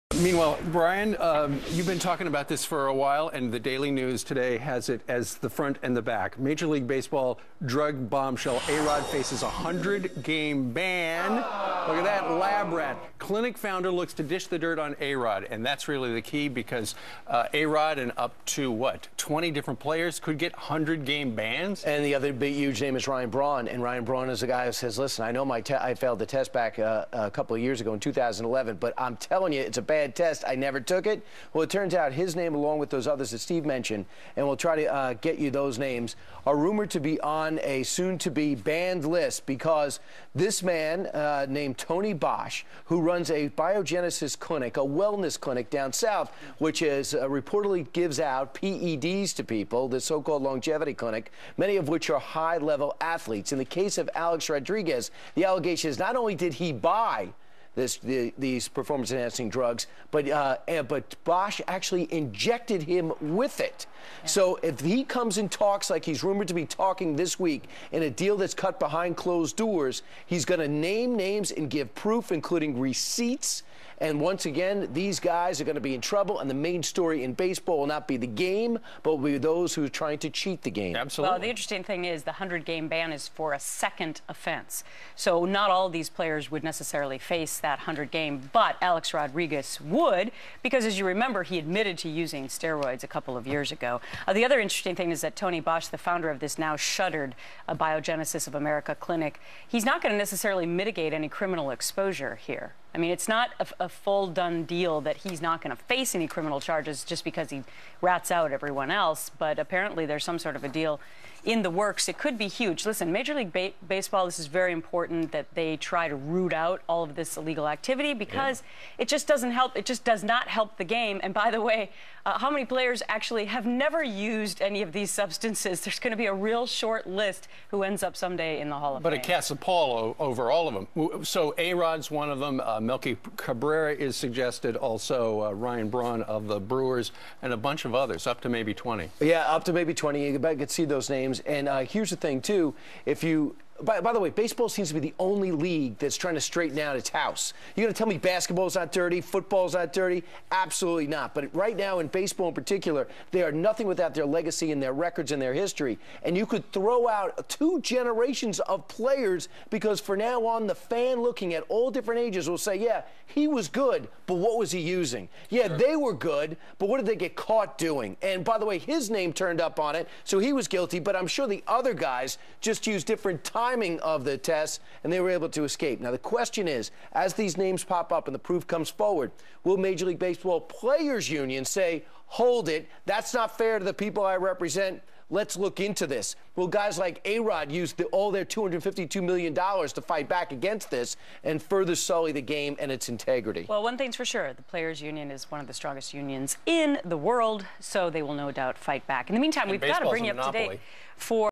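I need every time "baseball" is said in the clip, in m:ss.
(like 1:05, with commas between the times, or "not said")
0:06, 1:17, 1:53, 2:24, 2:32, 3:00.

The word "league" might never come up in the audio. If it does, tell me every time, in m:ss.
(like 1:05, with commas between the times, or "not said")
0:06, 1:53, 2:25, 3:00.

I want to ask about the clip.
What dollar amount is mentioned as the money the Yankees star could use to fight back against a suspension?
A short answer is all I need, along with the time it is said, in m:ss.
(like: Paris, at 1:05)
$252 million, at 3:08.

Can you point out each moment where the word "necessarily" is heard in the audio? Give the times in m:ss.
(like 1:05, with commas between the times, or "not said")
1:26, 1:40.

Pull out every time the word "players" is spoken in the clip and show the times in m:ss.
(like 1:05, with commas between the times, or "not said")
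0:19, 1:26, 2:02, 2:38, 3:00, 3:14.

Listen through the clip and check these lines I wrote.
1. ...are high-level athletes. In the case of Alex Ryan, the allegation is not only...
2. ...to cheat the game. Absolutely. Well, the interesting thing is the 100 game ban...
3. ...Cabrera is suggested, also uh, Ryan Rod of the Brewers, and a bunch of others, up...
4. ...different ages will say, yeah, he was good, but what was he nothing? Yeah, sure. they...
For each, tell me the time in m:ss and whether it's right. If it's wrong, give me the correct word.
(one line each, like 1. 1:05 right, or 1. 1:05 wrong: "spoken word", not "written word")
1. 0:52 wrong: "Rodriguez", not "Ryan"
2. 1:20 right
3. 2:13 wrong: "Braun", not "Rod"
4. 2:41 wrong: "using", not "nothing".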